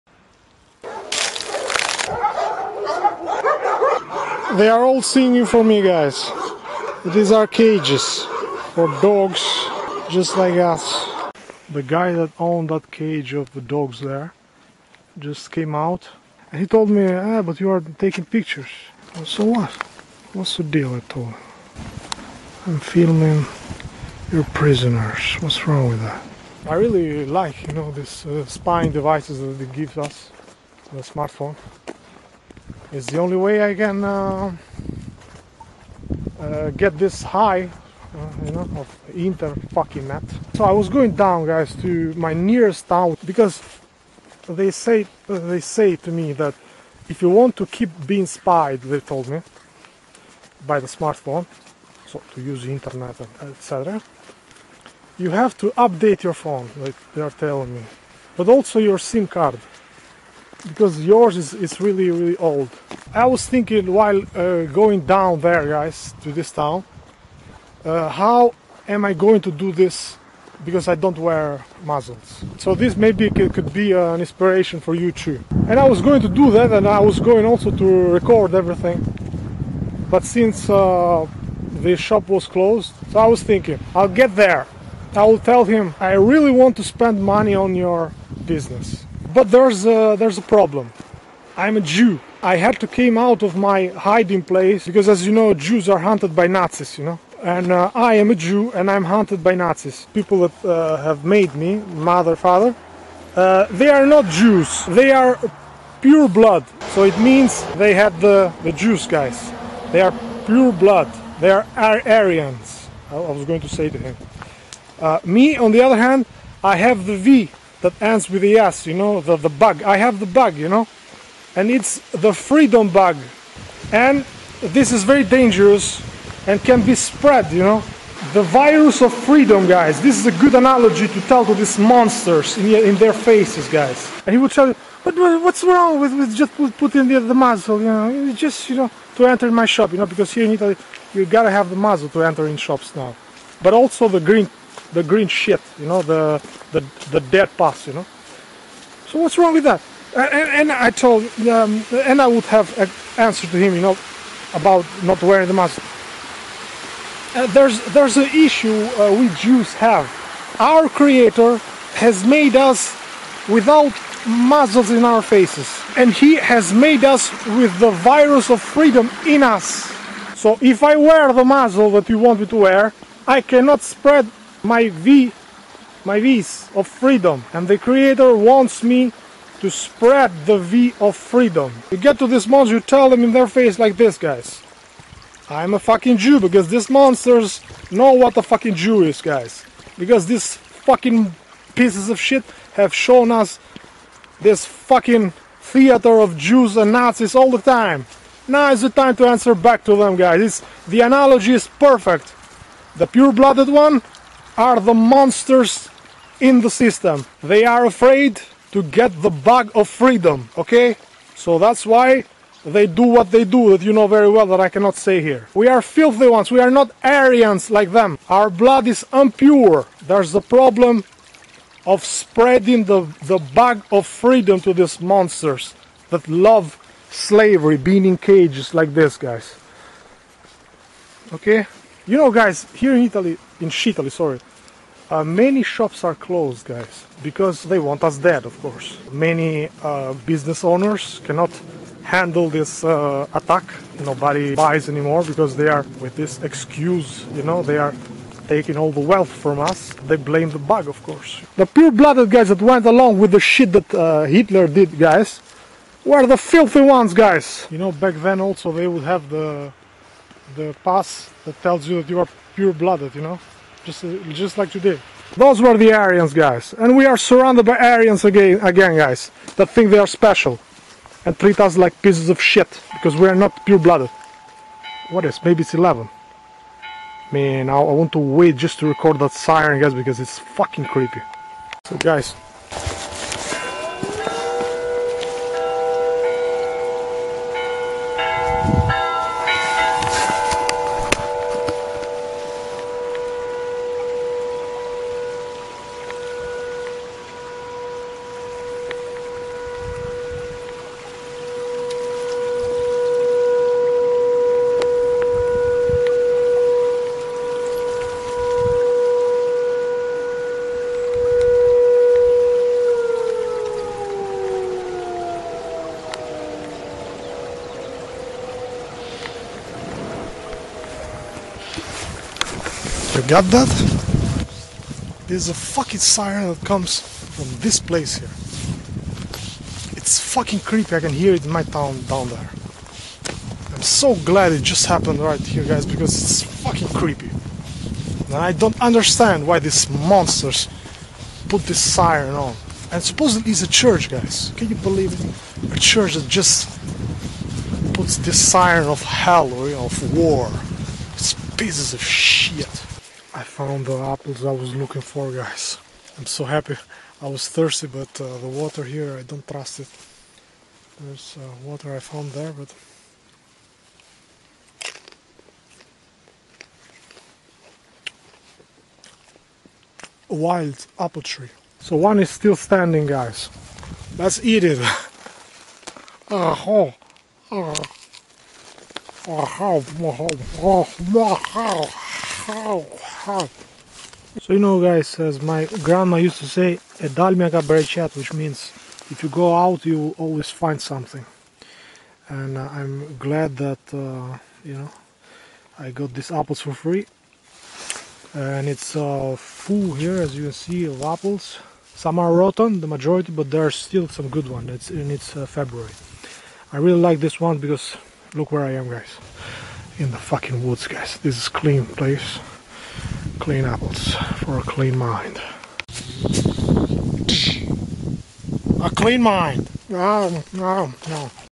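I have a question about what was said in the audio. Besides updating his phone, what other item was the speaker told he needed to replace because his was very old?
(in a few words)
SIM card.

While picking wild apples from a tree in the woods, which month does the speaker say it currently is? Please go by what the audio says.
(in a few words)
February.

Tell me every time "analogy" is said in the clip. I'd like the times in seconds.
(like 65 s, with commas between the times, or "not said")
130 s, 201 s.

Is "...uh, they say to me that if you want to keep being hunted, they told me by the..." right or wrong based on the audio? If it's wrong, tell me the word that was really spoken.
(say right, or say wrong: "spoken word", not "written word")
wrong: "spied", not "hunted".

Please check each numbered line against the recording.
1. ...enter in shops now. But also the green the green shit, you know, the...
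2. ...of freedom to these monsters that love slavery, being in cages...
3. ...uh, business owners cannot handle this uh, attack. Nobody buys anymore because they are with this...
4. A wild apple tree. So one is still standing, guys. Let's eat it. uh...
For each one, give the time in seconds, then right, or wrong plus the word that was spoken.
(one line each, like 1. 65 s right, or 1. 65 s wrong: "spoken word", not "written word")
1. 142 s right
2. 223 s right
3. 239 s right
4. 370 s right.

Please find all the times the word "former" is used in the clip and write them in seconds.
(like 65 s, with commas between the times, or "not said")
not said.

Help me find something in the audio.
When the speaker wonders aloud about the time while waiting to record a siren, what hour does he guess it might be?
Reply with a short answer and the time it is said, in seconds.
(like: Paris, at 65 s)
11, at 275 s.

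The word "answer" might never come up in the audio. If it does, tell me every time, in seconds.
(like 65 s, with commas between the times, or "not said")
153 s, 199 s.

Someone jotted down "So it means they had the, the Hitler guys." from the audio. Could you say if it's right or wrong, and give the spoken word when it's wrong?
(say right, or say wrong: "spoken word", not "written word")
wrong: "Jews", not "Hitler".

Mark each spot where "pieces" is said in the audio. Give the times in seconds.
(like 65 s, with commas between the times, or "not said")
191 s, 272 s, 351 s.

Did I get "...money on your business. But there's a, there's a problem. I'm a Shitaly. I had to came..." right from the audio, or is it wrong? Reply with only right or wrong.
wrong.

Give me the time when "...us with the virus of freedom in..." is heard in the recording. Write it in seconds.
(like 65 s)
167 s.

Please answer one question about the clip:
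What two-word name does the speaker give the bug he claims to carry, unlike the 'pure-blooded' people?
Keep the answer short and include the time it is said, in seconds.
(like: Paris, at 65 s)
freedom bug, at 122 s.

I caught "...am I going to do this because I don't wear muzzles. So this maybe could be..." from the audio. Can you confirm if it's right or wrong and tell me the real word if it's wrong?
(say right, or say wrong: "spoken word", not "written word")
right.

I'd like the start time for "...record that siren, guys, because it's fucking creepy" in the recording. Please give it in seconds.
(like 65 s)
278 s.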